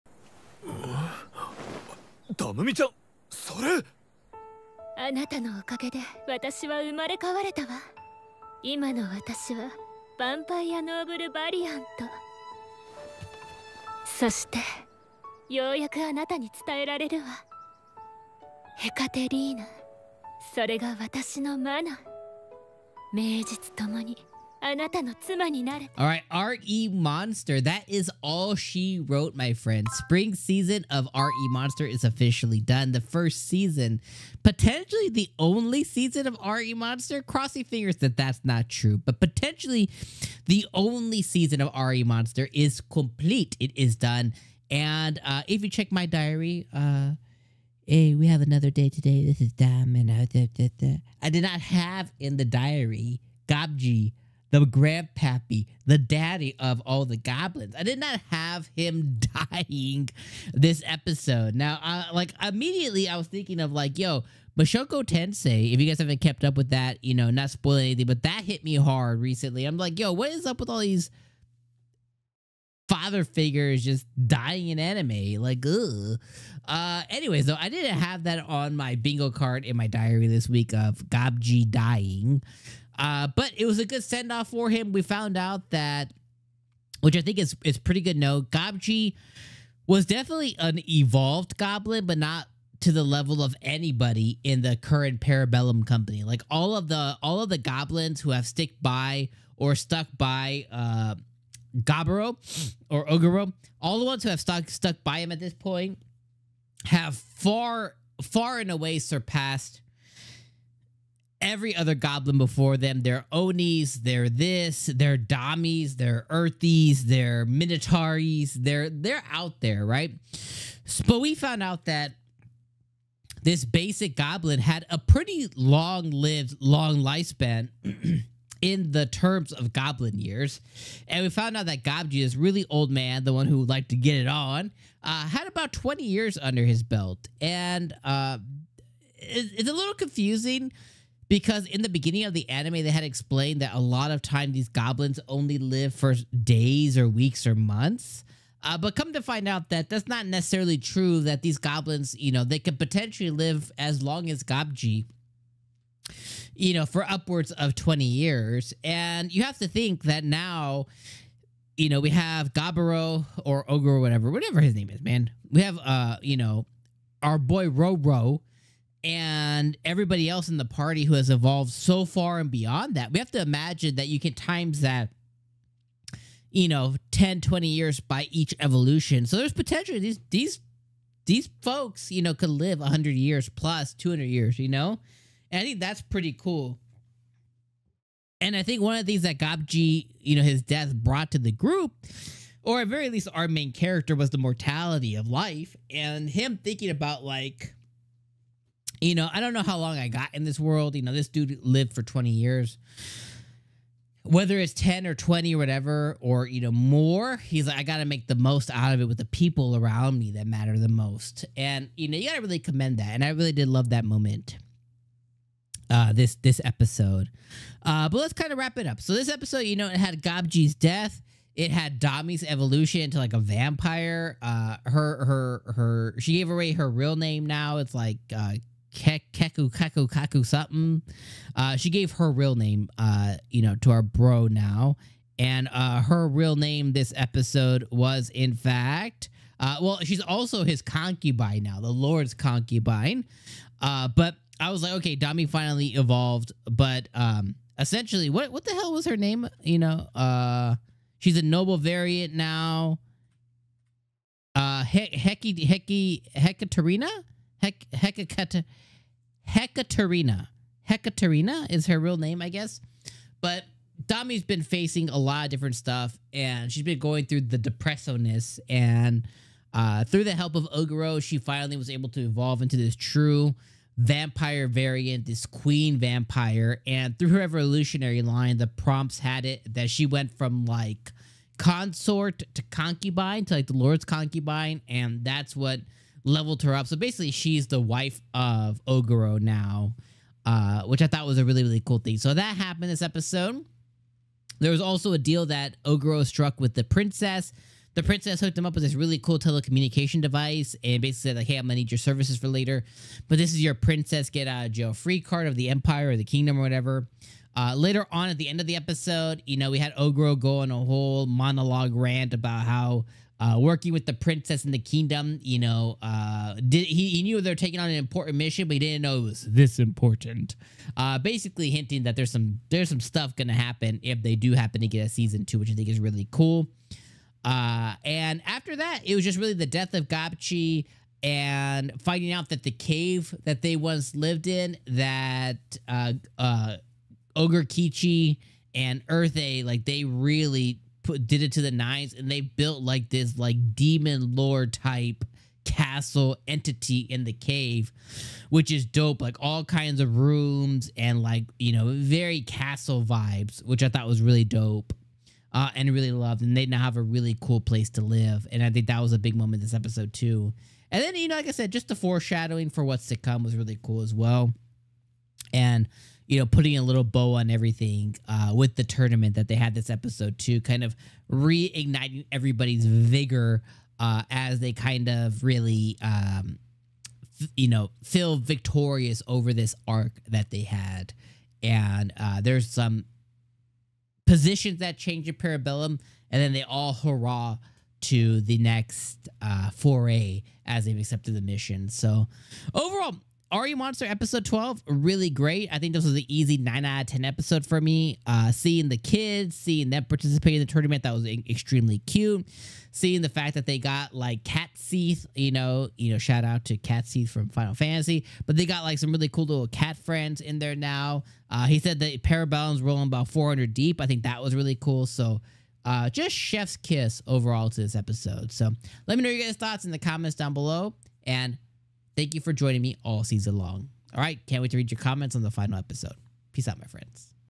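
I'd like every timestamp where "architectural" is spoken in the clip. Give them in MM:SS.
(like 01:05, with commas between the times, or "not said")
not said.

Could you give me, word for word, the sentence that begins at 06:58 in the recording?
So, let me know your guys' thoughts in the comments down below and Thank you for joining me all season long.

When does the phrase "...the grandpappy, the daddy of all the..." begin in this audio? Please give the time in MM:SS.
00:54.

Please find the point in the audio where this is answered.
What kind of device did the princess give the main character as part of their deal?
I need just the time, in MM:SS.
04:59.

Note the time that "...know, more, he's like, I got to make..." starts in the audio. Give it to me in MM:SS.
03:26.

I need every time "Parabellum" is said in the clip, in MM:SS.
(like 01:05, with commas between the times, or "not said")
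01:35, 06:25, 06:52.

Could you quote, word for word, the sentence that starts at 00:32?
The first season, potentially the only season of R.E.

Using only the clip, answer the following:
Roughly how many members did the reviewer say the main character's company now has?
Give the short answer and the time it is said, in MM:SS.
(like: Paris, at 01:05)
400, at 06:53.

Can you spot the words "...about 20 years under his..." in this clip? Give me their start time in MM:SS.
02:15.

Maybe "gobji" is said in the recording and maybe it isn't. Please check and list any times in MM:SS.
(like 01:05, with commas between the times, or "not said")
01:28, 02:11, 02:34, 03:40.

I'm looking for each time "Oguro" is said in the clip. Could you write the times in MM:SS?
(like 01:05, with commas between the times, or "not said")
01:43, 04:30, 04:48, 04:55.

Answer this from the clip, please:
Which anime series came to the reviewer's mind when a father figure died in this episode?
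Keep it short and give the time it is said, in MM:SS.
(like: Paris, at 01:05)
Mushoku Tensei, at 01:04.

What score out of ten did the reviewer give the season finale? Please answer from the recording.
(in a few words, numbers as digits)
9.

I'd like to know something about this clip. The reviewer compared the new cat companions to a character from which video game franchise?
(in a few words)
Final Fantasy.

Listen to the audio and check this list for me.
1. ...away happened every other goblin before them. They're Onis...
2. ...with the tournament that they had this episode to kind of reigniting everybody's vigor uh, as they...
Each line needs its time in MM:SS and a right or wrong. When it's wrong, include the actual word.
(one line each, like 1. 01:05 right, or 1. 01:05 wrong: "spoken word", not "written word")
1. 01:48 wrong: "surpassed", not "happened"
2. 06:08 right.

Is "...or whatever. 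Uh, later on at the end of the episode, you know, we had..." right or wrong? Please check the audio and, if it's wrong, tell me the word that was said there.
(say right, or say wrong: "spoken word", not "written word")
right.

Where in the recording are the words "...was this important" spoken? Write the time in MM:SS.
05:19.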